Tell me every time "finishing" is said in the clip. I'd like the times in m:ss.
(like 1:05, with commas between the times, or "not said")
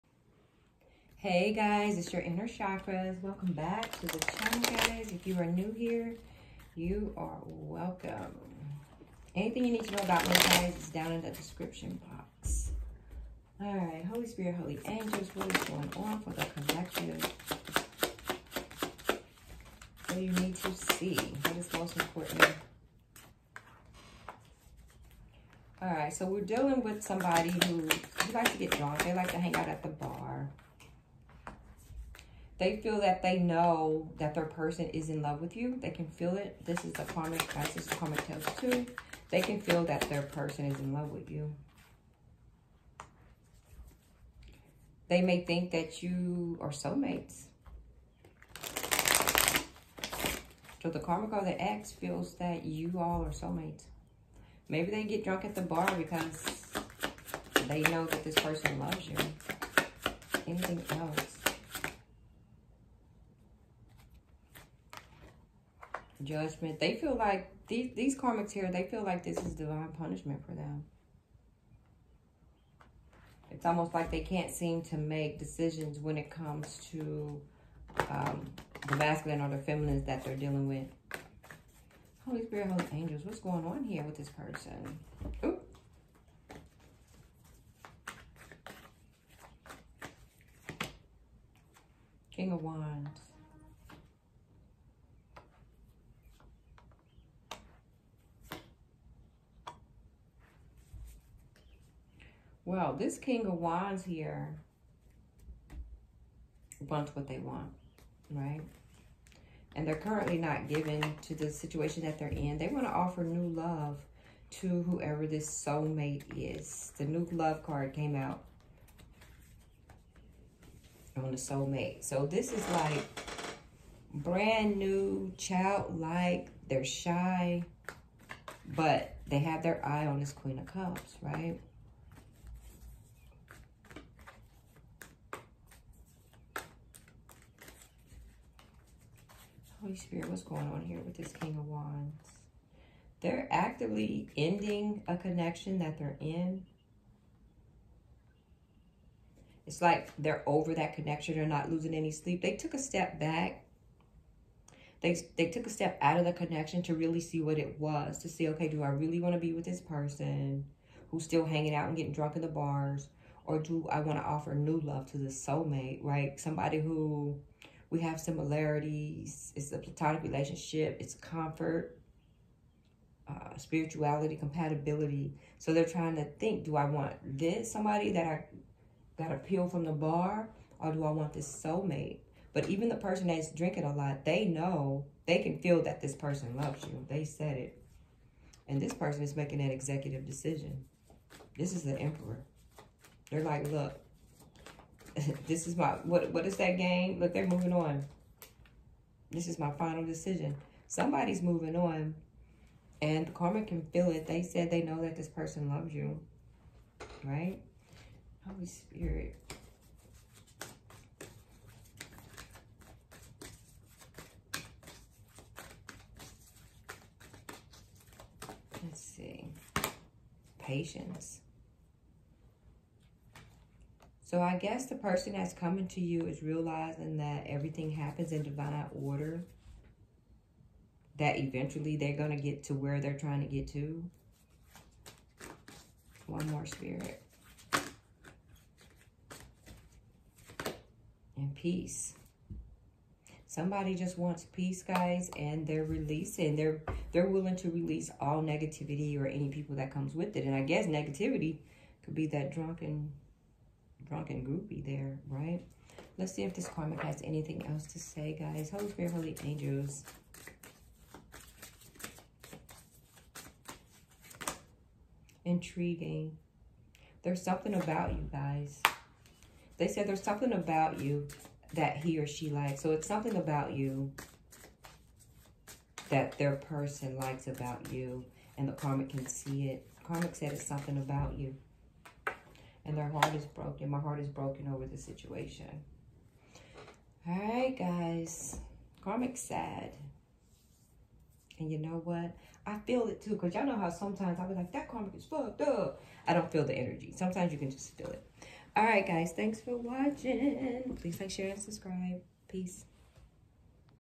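not said.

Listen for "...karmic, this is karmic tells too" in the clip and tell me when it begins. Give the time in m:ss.
0:37.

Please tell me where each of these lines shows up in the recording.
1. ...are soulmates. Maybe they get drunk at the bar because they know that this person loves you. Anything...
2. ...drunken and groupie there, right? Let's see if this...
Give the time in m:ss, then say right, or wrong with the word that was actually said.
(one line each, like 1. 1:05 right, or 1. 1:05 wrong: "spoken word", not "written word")
1. 0:53 right
2. 4:12 right.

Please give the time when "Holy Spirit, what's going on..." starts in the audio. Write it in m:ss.
2:19.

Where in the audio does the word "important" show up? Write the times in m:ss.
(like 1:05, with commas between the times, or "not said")
0:21.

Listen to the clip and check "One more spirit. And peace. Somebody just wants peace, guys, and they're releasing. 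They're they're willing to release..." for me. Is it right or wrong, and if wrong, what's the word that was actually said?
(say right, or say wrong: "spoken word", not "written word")
right.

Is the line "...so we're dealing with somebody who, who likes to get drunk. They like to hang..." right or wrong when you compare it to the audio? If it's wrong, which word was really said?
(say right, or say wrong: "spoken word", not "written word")
right.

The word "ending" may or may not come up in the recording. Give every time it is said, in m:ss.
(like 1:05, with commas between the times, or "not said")
2:24.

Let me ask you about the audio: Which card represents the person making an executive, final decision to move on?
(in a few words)
The Emperor.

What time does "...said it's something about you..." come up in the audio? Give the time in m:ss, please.
4:40.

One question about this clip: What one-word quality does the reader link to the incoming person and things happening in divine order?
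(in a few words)
Patience.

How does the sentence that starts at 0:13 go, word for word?
All right, Holy Spirit, Holy Angels, what is going on for the collective?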